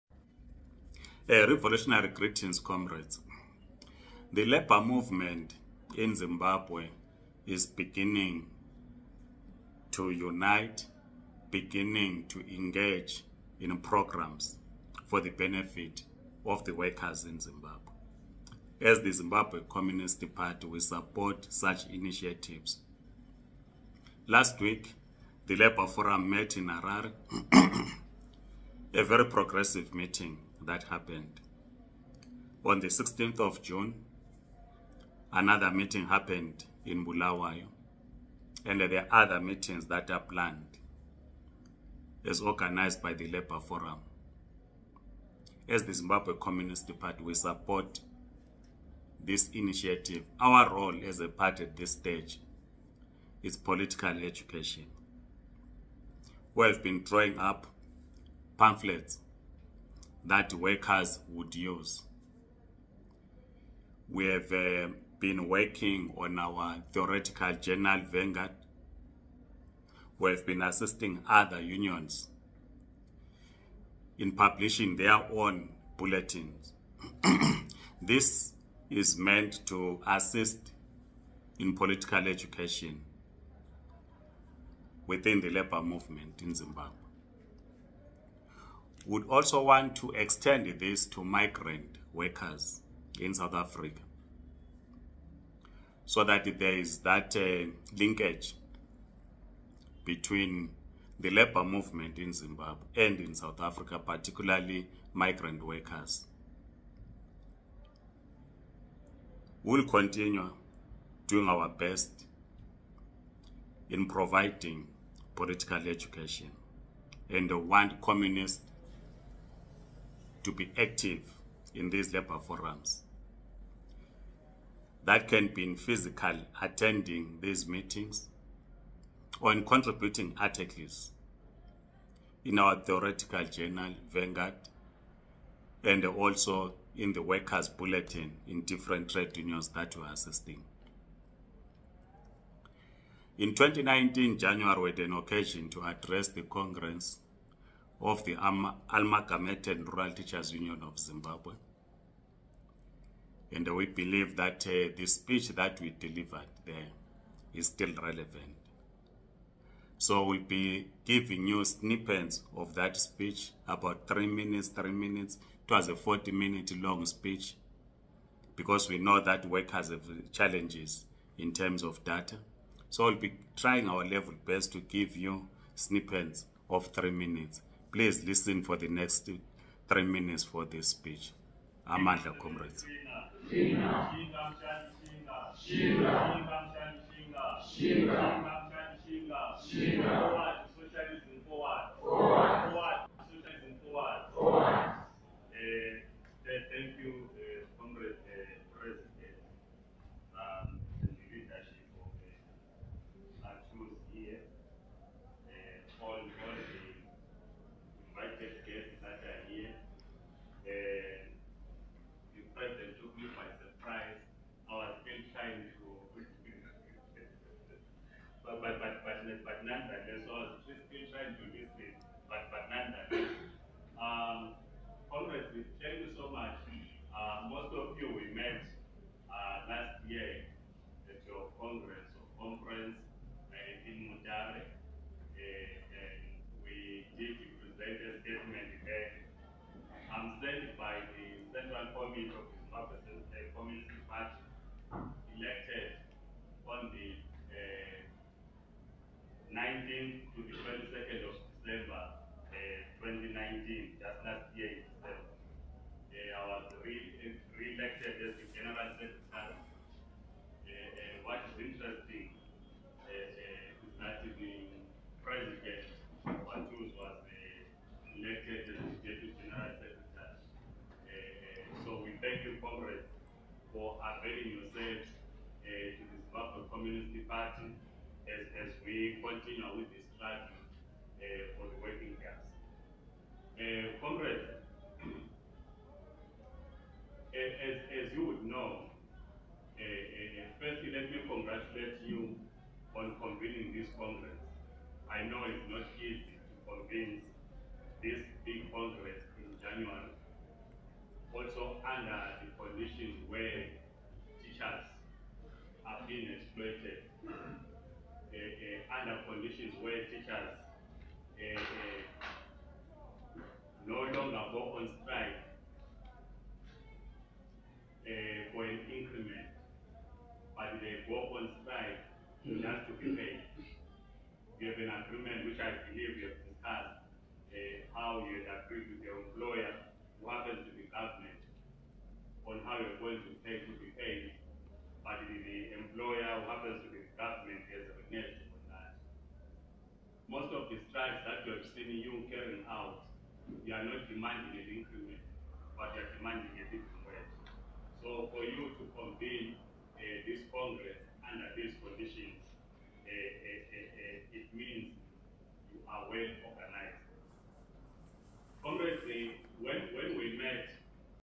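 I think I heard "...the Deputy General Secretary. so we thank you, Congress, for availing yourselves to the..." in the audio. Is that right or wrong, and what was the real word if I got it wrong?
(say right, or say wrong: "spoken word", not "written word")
right.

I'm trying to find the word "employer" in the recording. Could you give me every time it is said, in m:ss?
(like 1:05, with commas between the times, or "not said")
5:29, 5:35.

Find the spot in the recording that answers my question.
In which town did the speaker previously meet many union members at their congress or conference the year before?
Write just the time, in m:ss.
3:53.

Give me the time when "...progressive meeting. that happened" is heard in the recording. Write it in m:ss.
0:29.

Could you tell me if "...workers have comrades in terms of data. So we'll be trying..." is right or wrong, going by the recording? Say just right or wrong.
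wrong.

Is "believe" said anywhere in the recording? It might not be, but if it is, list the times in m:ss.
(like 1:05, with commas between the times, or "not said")
2:33, 5:25.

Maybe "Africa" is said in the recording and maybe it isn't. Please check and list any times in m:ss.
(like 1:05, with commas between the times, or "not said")
1:33, 1:43.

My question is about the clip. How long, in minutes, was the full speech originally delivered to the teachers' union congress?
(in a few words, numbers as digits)
40 minutes.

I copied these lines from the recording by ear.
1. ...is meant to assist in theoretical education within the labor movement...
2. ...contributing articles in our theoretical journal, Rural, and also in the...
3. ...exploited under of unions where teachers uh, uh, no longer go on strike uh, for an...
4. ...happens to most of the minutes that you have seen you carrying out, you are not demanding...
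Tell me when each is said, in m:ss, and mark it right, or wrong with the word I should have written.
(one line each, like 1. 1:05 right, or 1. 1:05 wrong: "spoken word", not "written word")
1. 1:18 wrong: "political", not "theoretical"
2. 2:09 wrong: "Vanguard", not "Rural"
3. 5:06 wrong: "conditions", not "unions"
4. 5:36 wrong: "strikes", not "minutes".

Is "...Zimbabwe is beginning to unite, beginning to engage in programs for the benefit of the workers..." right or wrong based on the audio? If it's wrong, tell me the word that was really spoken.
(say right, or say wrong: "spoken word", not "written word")
right.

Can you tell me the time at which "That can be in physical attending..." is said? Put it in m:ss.
2:05.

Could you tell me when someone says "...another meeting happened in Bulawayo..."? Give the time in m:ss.
0:35.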